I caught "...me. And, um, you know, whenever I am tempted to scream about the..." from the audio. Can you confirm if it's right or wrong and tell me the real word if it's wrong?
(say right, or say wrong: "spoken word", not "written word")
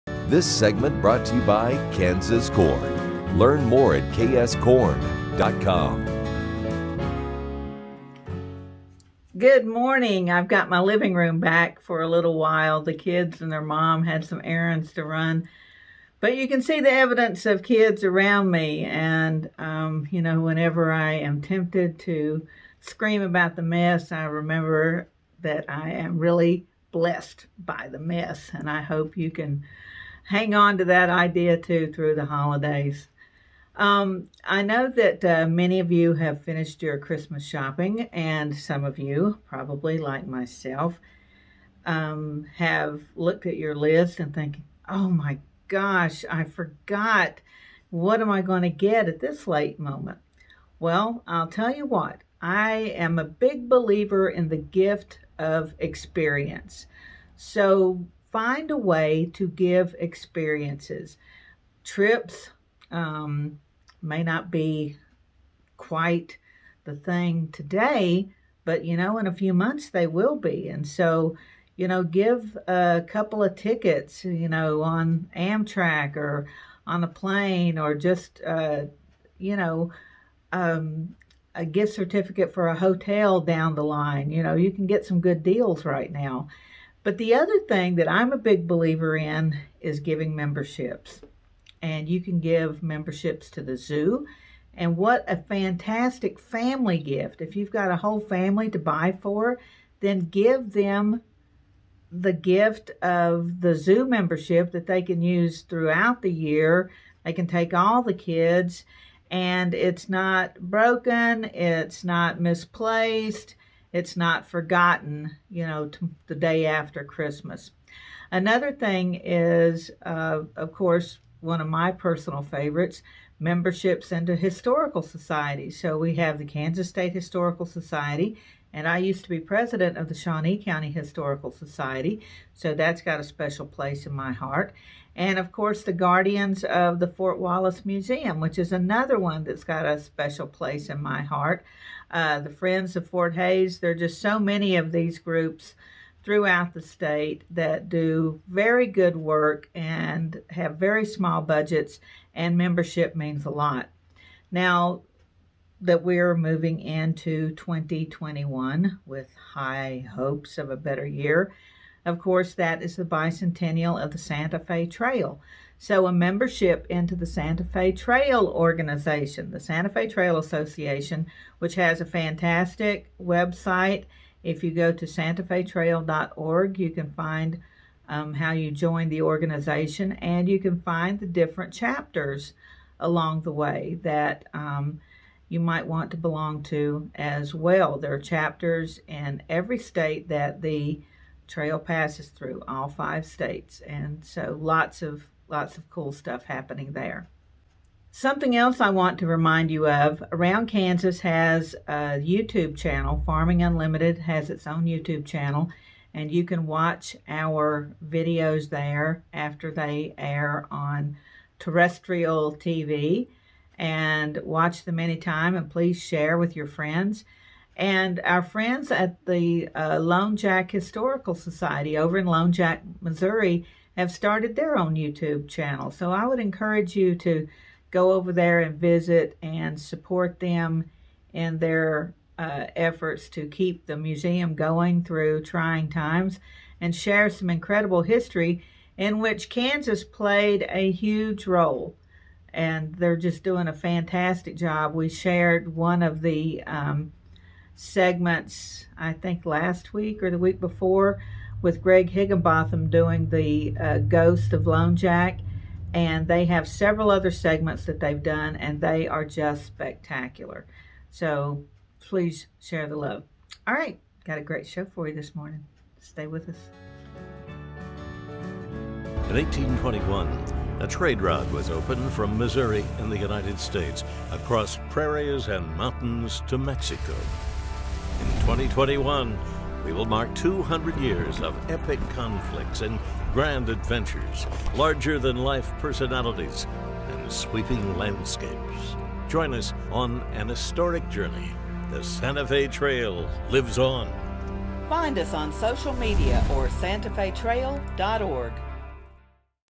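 right.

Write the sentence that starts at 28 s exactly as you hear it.
And I hope you can hang on to that idea too through the holidays.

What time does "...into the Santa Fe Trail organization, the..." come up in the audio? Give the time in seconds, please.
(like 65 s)
166 s.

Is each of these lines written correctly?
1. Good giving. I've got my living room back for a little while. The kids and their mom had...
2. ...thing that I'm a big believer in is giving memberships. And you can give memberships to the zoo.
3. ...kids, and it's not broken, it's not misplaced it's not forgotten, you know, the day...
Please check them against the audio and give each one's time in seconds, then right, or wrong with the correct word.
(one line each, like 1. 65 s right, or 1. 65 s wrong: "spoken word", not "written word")
1. 9 s wrong: "morning", not "giving"
2. 87 s right
3. 108 s right.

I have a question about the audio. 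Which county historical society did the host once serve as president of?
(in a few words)
Shawnee County Historical Society.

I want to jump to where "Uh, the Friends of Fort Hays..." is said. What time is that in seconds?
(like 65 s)
142 s.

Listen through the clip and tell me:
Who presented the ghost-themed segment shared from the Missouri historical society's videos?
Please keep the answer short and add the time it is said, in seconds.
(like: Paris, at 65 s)
Greg Higginbotham, at 251 s.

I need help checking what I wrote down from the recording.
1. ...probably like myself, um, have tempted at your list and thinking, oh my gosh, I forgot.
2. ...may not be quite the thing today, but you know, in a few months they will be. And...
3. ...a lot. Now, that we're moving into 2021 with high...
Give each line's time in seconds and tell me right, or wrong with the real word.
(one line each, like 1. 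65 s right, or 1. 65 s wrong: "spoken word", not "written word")
1. 39 s wrong: "looked", not "tempted"
2. 64 s right
3. 153 s right.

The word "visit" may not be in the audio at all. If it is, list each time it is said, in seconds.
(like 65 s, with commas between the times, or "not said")
228 s.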